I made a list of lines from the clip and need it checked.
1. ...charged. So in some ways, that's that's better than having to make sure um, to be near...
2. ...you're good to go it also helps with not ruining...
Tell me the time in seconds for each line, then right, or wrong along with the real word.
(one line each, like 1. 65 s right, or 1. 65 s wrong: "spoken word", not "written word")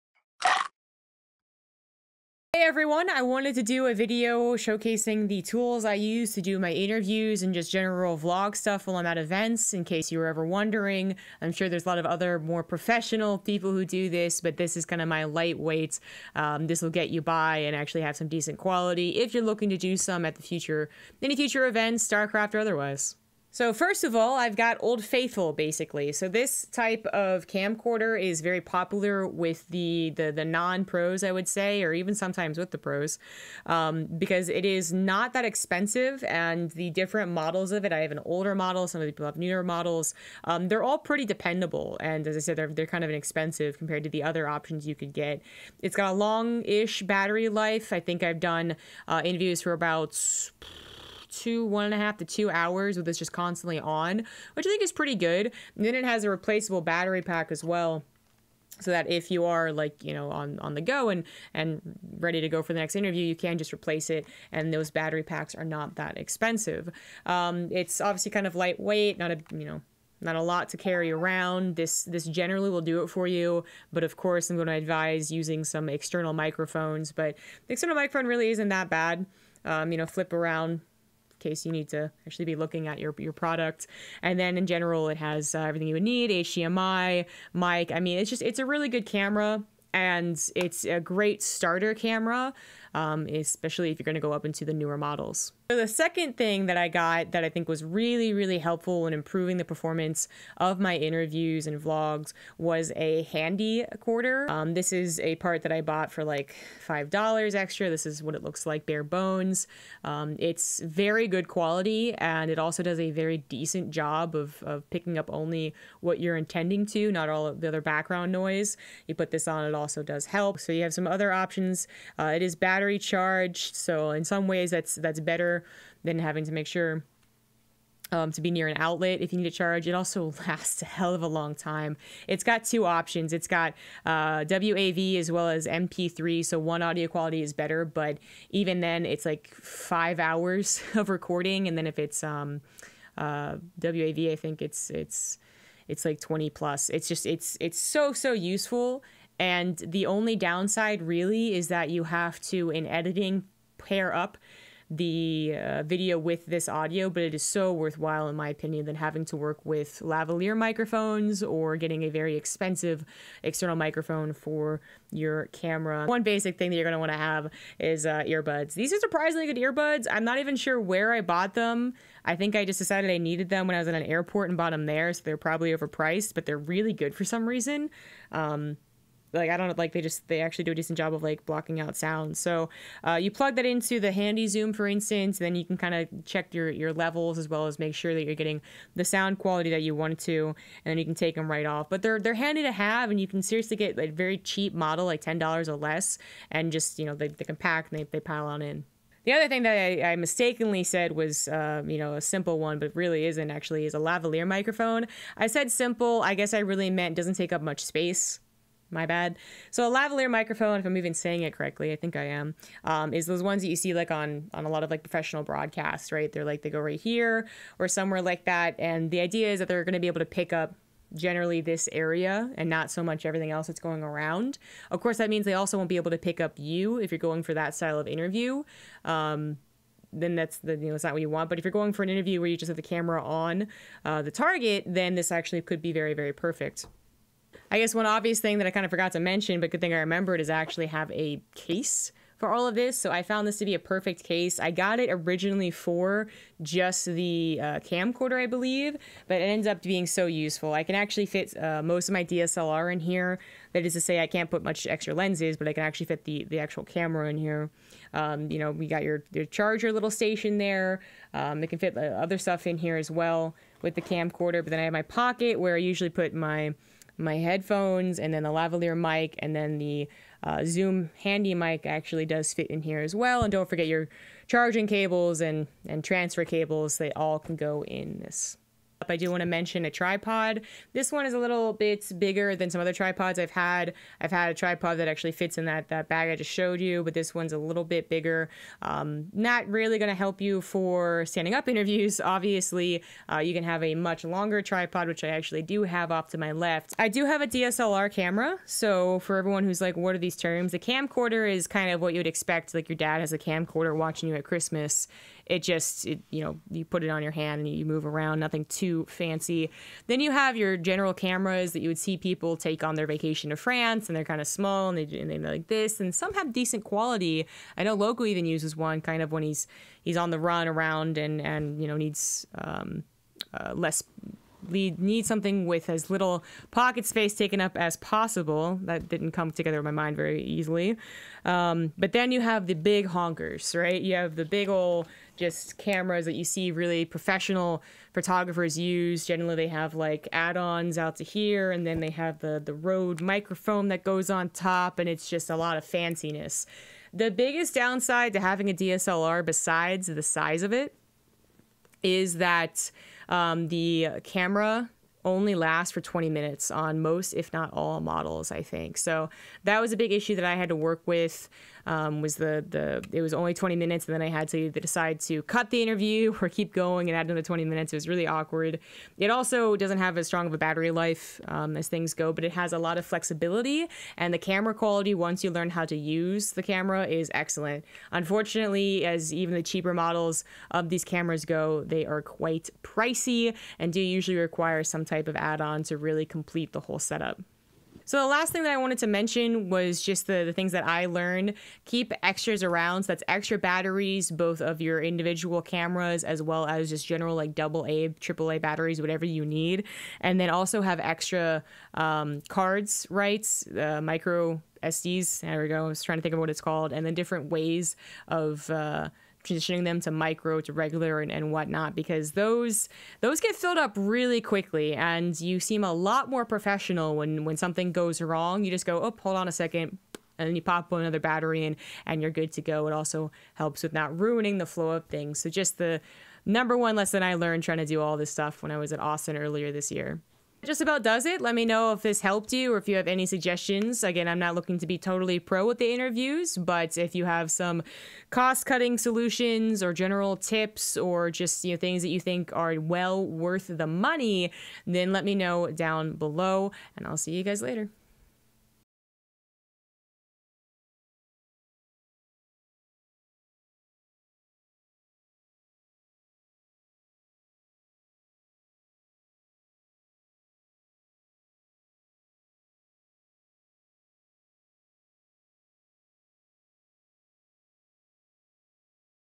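1. 122 s right
2. 422 s right.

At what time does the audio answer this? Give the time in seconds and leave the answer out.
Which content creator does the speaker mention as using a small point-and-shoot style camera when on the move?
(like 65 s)
317 s.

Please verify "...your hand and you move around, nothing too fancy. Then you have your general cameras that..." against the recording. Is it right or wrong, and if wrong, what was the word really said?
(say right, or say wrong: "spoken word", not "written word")
right.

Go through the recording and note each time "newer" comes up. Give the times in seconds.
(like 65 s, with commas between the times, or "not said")
39 s, 94 s.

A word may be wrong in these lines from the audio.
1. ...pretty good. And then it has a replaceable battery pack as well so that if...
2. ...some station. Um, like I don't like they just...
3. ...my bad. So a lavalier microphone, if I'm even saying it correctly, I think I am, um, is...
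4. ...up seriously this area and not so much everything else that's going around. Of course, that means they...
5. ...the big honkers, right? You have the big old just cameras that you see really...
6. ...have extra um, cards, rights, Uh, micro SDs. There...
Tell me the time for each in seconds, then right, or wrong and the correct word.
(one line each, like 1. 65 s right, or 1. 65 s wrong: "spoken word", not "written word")
1. 54 s right
2. 177 s wrong: "reason", not "station"
3. 208 s right
4. 220 s wrong: "generally", not "seriously"
5. 332 s right
6. 400 s right.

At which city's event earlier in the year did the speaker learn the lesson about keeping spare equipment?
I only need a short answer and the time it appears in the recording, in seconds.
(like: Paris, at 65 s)
Austin, at 428 s.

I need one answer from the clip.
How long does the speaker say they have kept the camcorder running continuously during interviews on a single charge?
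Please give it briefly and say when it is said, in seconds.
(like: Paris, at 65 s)
1.5 to 2 hours, at 51 s.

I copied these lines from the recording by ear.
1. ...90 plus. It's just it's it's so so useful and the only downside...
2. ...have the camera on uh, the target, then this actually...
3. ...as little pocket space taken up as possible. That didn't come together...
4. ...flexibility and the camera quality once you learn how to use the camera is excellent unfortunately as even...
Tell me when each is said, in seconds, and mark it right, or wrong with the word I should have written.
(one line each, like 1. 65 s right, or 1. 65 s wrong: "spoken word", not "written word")
1. 146 s wrong: "20", not "90"
2. 232 s right
3. 325 s right
4. 373 s right.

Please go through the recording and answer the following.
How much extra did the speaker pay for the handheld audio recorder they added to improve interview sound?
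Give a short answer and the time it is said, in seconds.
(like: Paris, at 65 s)
$5, at 106 s.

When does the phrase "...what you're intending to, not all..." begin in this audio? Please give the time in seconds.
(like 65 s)
116 s.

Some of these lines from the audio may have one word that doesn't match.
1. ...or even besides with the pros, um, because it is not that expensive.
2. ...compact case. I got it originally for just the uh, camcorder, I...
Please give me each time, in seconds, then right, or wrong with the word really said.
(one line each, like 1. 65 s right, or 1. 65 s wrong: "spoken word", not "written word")
1. 31 s wrong: "sometimes", not "besides"
2. 243 s wrong: "perfect", not "compact".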